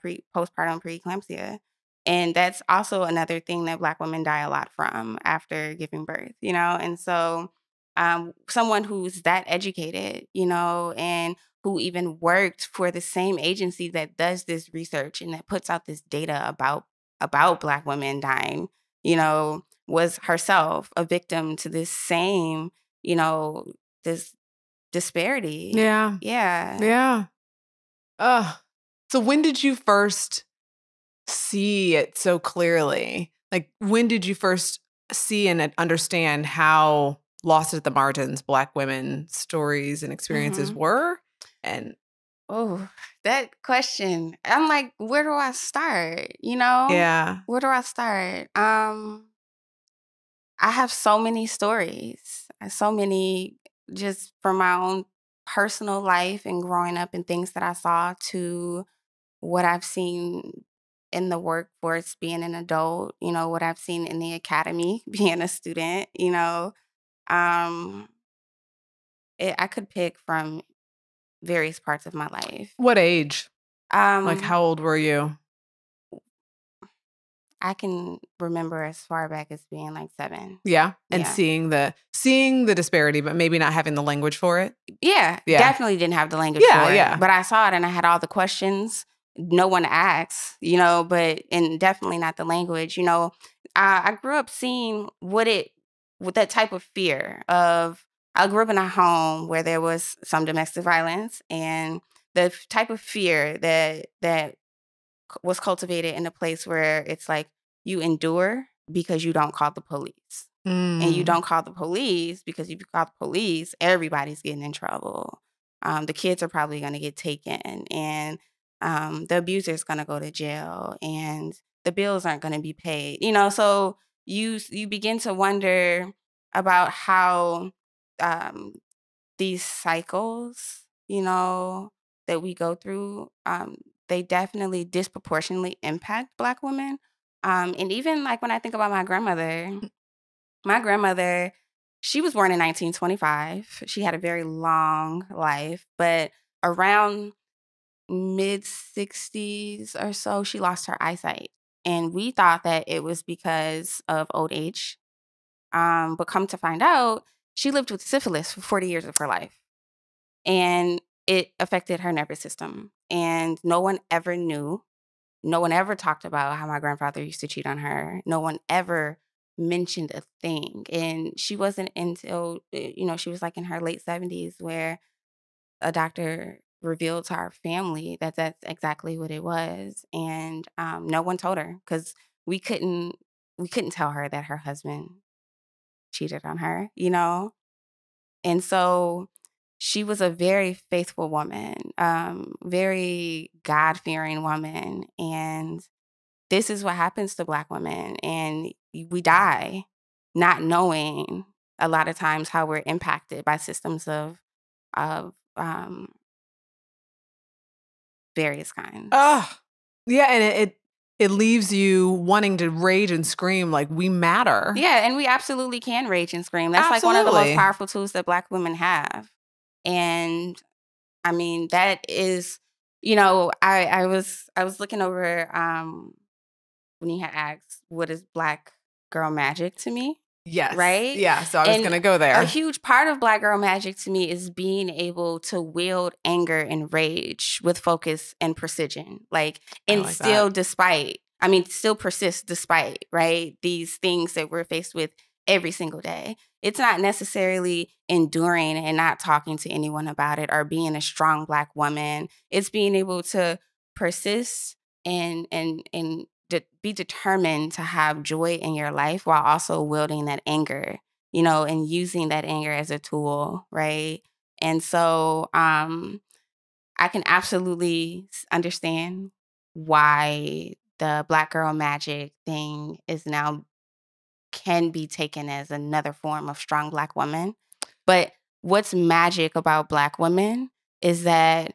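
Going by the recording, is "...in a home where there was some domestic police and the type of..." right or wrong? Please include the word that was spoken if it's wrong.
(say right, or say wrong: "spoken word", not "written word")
wrong: "violence", not "police".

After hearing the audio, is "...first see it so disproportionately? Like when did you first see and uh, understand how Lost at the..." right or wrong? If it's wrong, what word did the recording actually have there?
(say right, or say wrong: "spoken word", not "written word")
wrong: "clearly", not "disproportionately".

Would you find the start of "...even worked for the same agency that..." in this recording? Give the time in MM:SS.
00:11.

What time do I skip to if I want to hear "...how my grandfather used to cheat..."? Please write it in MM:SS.
02:46.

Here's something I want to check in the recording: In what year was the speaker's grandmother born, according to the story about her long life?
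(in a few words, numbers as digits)
1925.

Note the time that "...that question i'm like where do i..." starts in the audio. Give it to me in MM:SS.
00:43.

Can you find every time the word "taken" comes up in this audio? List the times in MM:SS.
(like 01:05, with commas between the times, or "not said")
01:57, 04:35.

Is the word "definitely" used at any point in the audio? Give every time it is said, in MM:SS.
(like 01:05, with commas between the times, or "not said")
01:25, 01:31, 02:14.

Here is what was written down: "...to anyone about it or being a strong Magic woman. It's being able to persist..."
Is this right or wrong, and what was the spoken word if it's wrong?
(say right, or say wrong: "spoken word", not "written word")
wrong: "Black", not "Magic".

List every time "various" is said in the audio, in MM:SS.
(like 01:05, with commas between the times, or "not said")
01:11, 03:28.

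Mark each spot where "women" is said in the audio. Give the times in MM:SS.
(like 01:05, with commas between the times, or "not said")
00:03, 00:17, 00:38, 02:16, 03:17, 03:38, 04:40.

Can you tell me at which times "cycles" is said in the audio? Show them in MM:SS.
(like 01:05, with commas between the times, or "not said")
02:09.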